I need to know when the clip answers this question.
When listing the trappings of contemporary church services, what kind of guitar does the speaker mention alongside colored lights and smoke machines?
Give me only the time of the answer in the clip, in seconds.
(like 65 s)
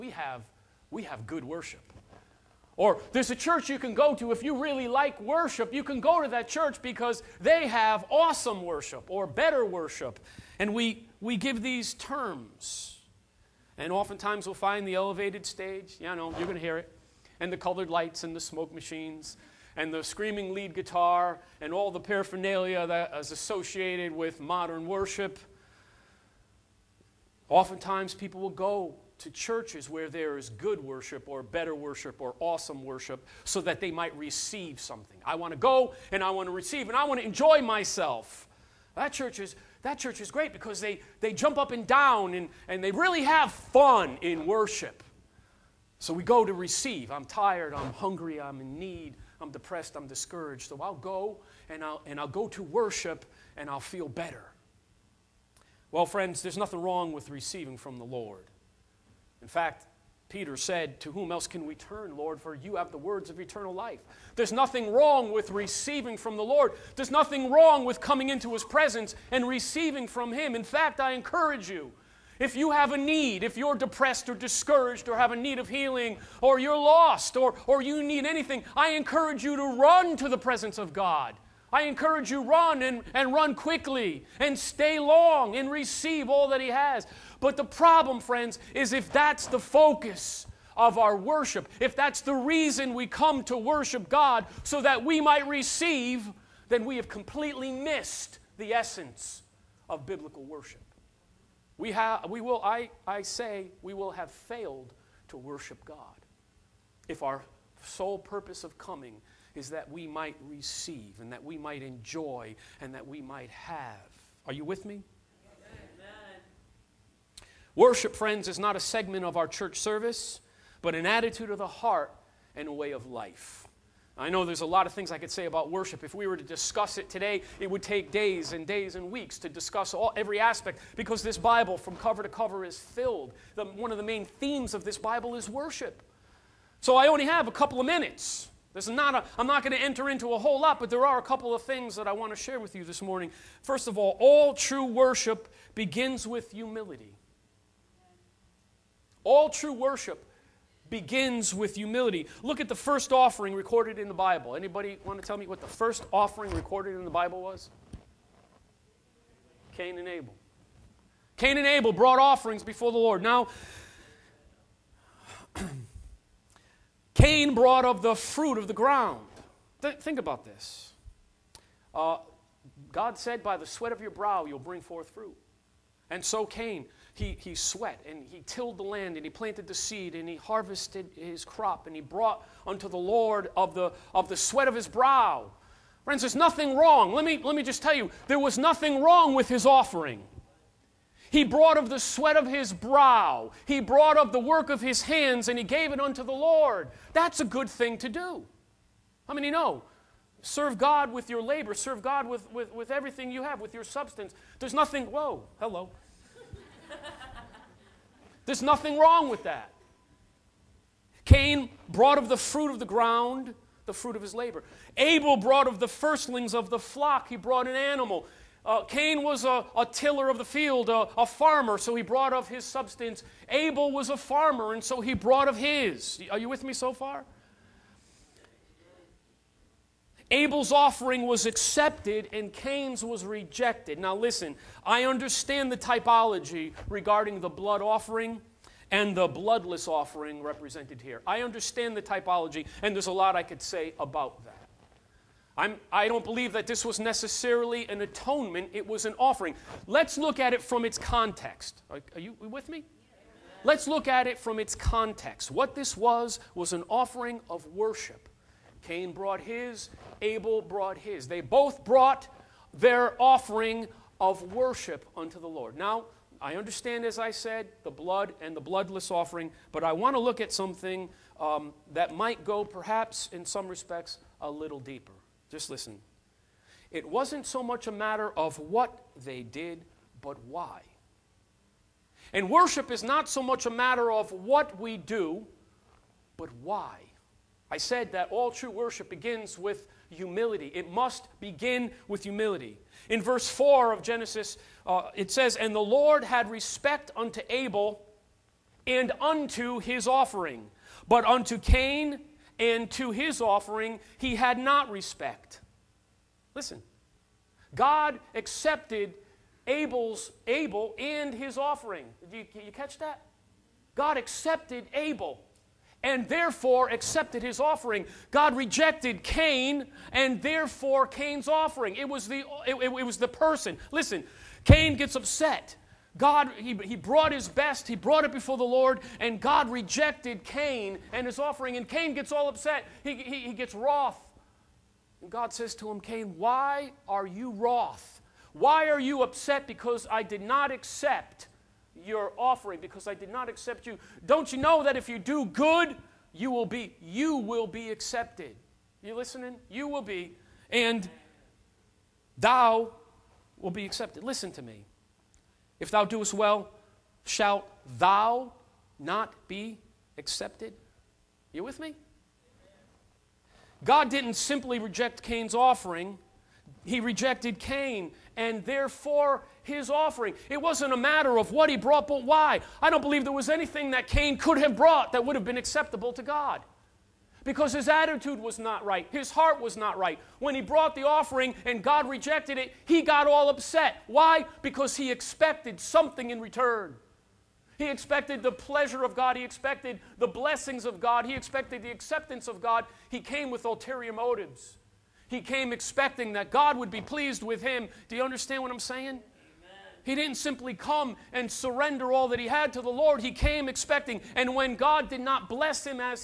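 20 s.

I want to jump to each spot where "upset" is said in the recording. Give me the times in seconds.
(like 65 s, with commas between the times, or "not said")
325 s, 332 s, 339 s, 383 s.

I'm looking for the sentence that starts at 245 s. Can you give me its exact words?
I'm, I do not believe that this was necessarily an atonement, it was an offering.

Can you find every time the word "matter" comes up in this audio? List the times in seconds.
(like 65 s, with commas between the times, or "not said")
277 s, 283 s, 370 s.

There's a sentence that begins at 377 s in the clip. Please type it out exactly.
Because his attitude was not right, his heart was not right.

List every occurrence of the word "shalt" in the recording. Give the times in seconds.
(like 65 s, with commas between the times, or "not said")
357 s.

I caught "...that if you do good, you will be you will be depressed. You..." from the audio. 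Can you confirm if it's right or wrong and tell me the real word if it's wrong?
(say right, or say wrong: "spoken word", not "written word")
wrong: "accepted", not "depressed".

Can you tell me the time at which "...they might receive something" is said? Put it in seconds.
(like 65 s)
33 s.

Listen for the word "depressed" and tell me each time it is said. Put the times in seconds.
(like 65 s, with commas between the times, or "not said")
49 s, 73 s.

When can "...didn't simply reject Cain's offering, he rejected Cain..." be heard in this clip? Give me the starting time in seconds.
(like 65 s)
364 s.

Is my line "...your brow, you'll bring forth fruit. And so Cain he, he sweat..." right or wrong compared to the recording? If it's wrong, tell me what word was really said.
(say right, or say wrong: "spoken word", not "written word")
right.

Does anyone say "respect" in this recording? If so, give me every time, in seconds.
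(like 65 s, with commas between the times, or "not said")
273 s, 296 s, 304 s.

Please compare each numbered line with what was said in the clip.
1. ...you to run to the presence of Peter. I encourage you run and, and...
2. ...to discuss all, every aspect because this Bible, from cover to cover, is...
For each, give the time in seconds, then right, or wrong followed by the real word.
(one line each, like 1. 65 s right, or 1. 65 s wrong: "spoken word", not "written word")
1. 79 s wrong: "God", not "Peter"
2. 129 s right.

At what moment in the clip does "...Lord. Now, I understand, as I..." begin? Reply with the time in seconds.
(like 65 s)
265 s.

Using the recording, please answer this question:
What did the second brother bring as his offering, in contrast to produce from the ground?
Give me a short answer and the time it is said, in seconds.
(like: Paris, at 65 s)
The firstlings of the flock, at 215 s.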